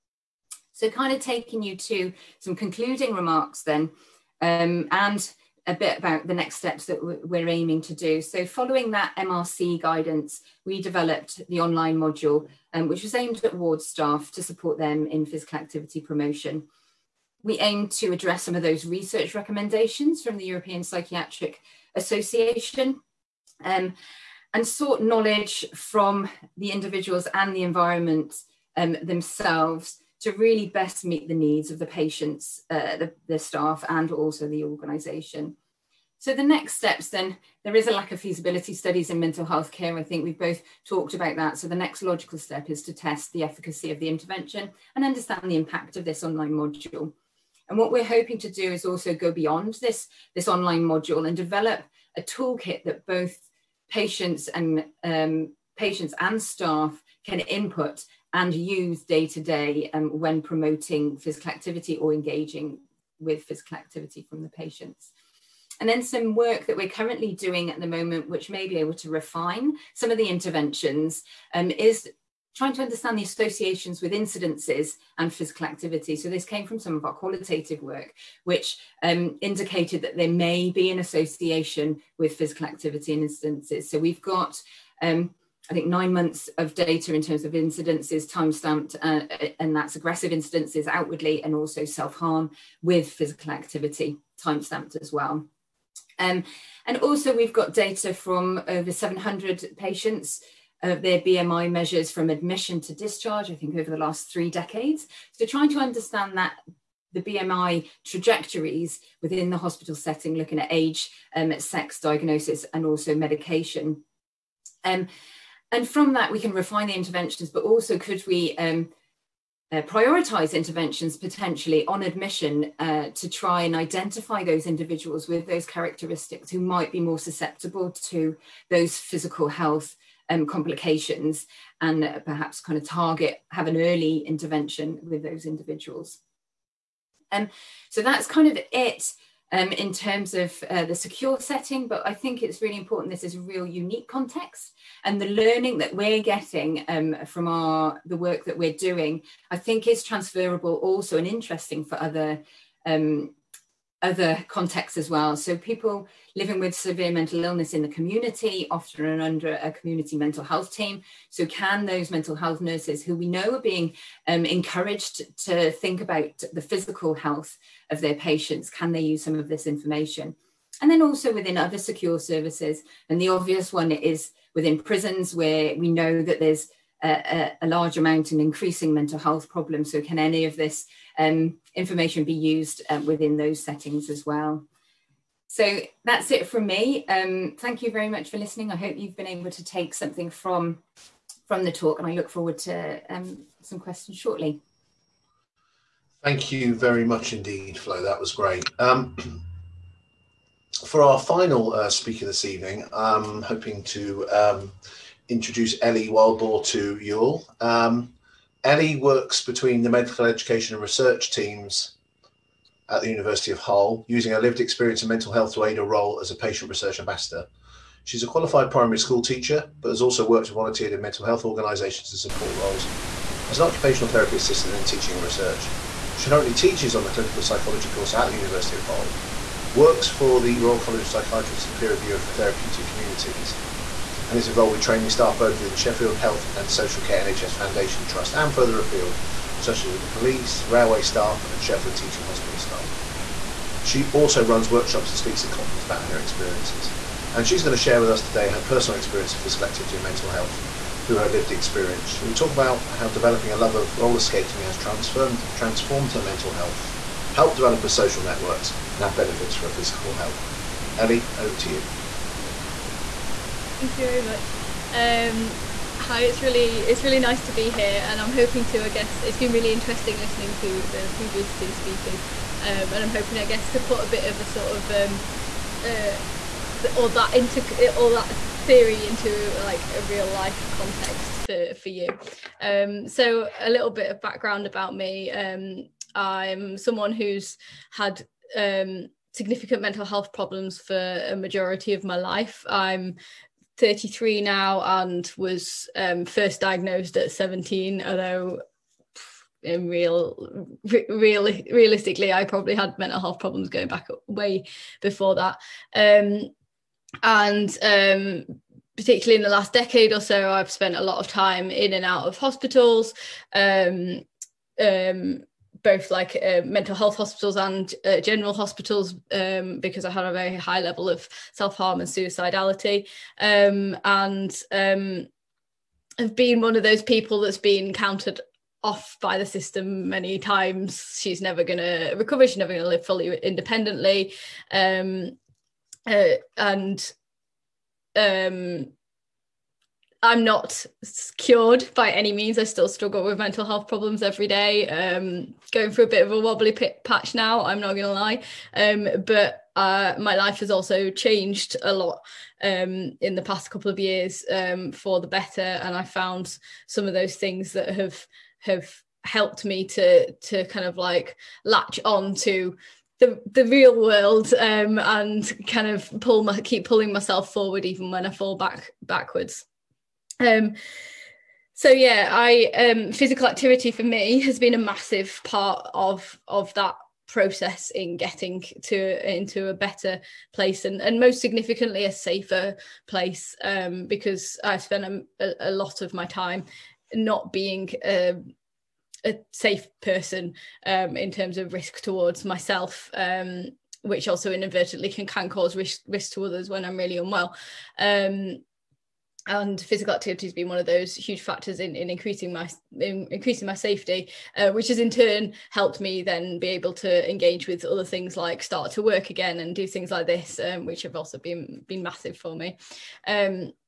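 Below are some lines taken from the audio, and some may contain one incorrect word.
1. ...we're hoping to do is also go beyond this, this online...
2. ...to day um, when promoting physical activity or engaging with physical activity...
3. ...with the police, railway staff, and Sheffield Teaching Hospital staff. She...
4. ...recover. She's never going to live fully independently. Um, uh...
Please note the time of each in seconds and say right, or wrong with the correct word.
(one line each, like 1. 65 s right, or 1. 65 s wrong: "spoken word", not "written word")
1. 47 s right
2. 59 s right
3. 239 s right
4. 332 s right.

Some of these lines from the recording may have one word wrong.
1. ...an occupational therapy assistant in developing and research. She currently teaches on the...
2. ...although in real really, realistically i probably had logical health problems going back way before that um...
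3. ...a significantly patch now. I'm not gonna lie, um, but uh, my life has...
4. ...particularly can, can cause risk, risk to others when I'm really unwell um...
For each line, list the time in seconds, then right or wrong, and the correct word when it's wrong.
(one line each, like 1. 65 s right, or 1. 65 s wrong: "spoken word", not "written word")
1. 223 s wrong: "teaching", not "developing"
2. 298 s wrong: "mental", not "logical"
3. 346 s wrong: "wobbly", not "significantly"
4. 394 s wrong: "inadvertently", not "particularly".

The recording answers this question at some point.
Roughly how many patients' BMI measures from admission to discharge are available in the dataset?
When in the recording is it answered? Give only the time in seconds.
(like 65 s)
98 s.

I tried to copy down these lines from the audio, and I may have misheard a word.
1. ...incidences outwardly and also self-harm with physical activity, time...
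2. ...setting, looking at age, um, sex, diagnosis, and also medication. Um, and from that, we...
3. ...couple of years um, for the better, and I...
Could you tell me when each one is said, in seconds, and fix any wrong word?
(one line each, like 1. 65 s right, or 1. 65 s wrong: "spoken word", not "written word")
1. 90 s right
2. 109 s right
3. 353 s right.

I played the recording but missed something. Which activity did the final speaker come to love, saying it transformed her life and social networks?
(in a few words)
roller skating.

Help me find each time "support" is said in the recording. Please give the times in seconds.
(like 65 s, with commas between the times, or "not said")
14 s, 222 s.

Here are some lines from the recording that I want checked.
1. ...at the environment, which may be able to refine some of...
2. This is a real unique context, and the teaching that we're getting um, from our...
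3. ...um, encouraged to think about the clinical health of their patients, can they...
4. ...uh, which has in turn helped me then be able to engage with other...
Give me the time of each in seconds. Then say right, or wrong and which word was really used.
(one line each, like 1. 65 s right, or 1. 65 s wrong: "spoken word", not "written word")
1. 67 s wrong: "moment", not "environment"
2. 143 s wrong: "learning", not "teaching"
3. 164 s wrong: "physical", not "clinical"
4. 404 s right.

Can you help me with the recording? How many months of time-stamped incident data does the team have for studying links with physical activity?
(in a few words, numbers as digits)
9.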